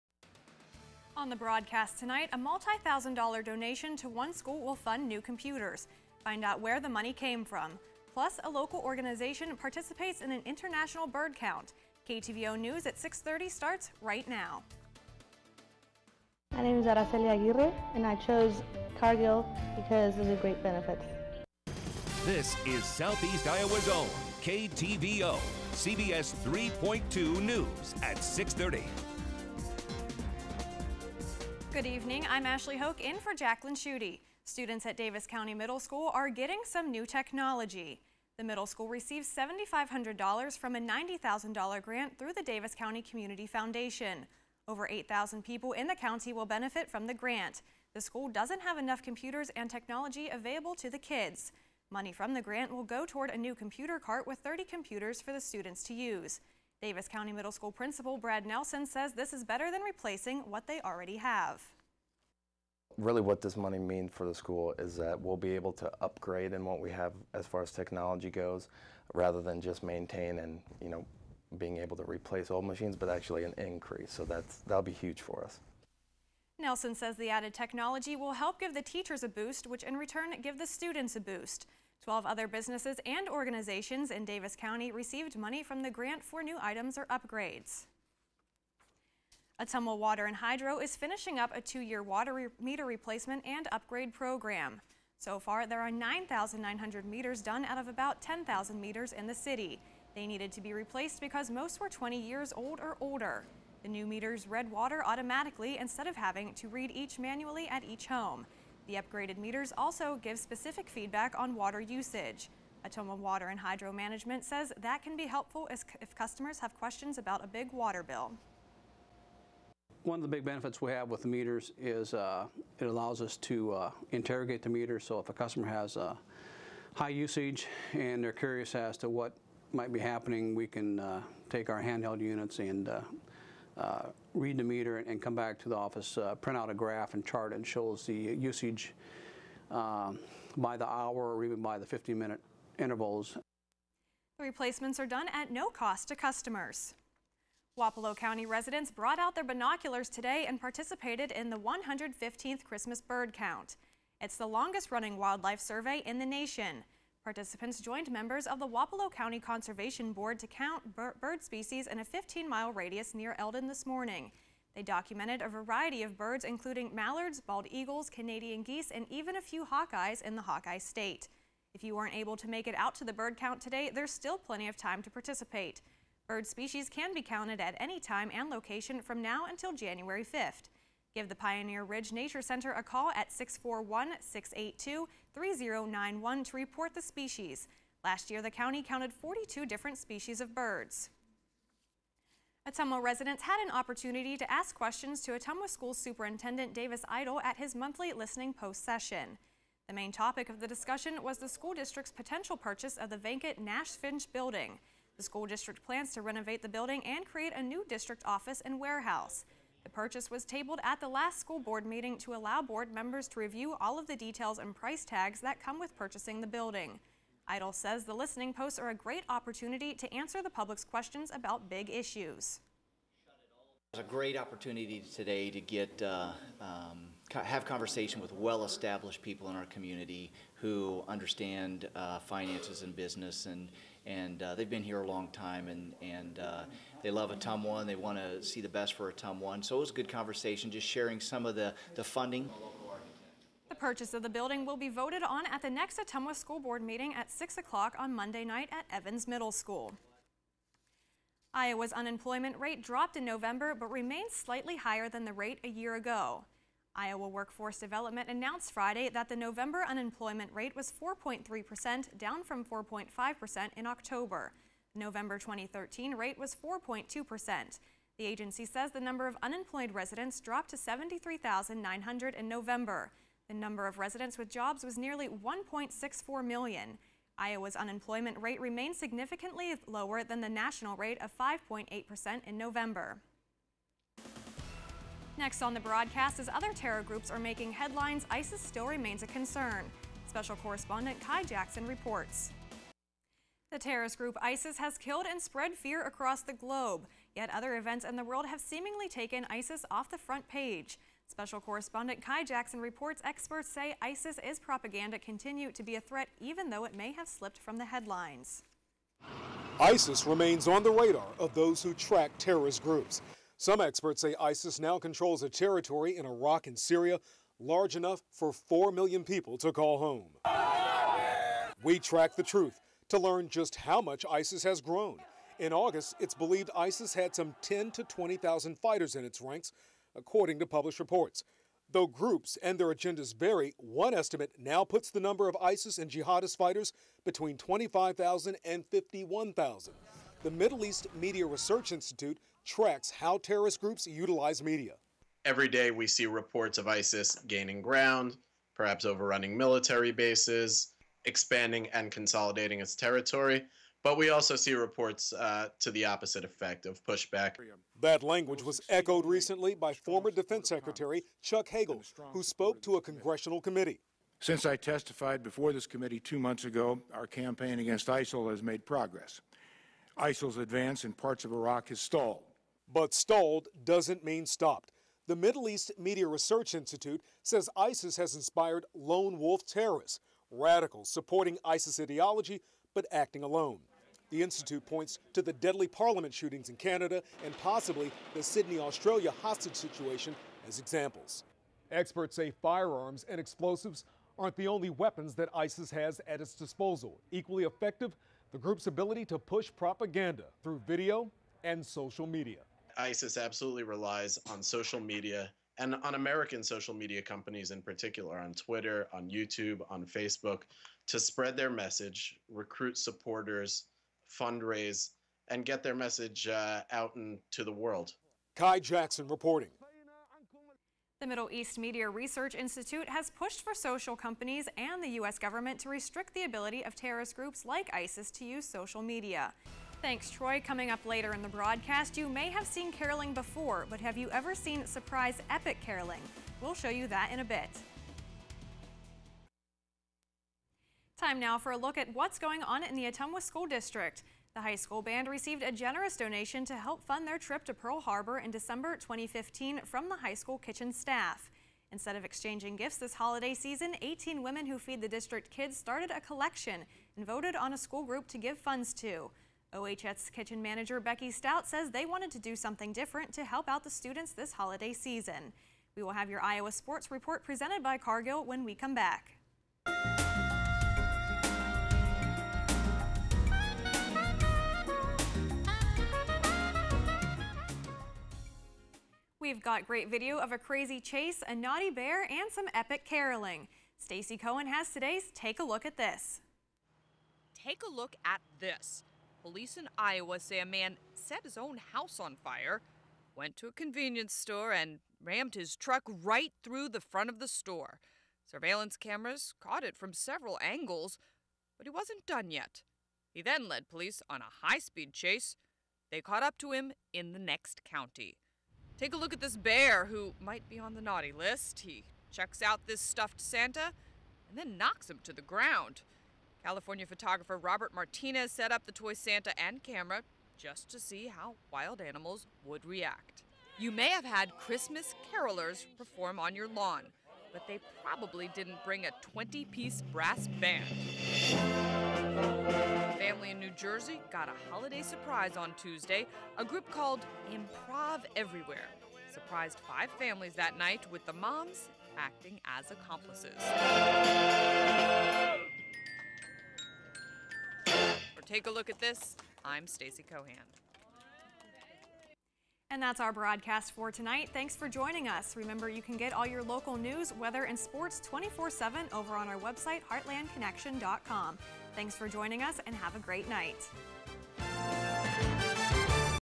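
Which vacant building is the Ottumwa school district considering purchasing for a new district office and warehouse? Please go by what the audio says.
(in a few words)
Nash Finch building.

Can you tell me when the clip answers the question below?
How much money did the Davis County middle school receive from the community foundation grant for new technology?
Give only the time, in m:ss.
0:39.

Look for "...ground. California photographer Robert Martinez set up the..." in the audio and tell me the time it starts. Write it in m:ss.
8:35.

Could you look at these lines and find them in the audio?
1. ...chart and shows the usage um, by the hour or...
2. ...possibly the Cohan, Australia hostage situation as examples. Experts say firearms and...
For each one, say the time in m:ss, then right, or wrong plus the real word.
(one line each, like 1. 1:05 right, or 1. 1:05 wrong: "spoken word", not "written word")
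1. 2:17 right
2. 6:27 wrong: "Sydney", not "Cohan".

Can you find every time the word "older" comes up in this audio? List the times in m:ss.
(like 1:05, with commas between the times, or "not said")
1:42.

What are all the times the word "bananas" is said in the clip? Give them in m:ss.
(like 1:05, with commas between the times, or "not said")
not said.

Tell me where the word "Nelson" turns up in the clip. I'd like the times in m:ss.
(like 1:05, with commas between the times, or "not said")
0:58, 1:16.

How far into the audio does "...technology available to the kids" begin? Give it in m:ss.
0:49.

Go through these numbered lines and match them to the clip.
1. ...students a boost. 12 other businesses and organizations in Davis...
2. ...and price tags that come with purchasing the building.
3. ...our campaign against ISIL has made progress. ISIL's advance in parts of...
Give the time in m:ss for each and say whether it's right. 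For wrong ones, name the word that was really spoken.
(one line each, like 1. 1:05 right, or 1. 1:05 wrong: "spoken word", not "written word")
1. 1:20 right
2. 3:34 right
3. 6:07 right.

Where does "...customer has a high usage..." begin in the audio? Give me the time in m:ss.
2:05.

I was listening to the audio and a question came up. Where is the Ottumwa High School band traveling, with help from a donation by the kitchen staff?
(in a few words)
Pearl Harbor.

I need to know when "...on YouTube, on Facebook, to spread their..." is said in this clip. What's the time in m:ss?
6:49.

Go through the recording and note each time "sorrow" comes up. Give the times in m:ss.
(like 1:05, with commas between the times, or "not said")
not said.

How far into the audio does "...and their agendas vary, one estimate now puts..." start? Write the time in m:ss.
5:32.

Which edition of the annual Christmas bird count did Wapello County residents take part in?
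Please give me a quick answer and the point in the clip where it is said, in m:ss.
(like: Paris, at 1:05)
115th, at 2:31.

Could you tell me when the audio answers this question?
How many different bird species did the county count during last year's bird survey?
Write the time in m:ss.
3:09.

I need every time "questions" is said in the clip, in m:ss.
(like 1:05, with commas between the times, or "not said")
1:56, 3:14, 3:40.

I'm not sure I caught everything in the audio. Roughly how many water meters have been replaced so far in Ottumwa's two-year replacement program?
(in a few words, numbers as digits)
9,900.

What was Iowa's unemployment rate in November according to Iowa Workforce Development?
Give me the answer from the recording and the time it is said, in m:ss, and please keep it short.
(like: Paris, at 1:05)
4.3%, at 4:21.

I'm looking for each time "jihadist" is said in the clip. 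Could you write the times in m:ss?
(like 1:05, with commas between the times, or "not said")
5:36.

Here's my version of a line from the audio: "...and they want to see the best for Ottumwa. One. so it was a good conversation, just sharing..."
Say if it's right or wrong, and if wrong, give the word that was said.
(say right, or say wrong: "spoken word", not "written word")
right.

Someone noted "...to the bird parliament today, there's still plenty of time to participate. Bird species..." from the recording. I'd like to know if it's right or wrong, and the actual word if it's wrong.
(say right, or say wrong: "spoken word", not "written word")
wrong: "count", not "parliament".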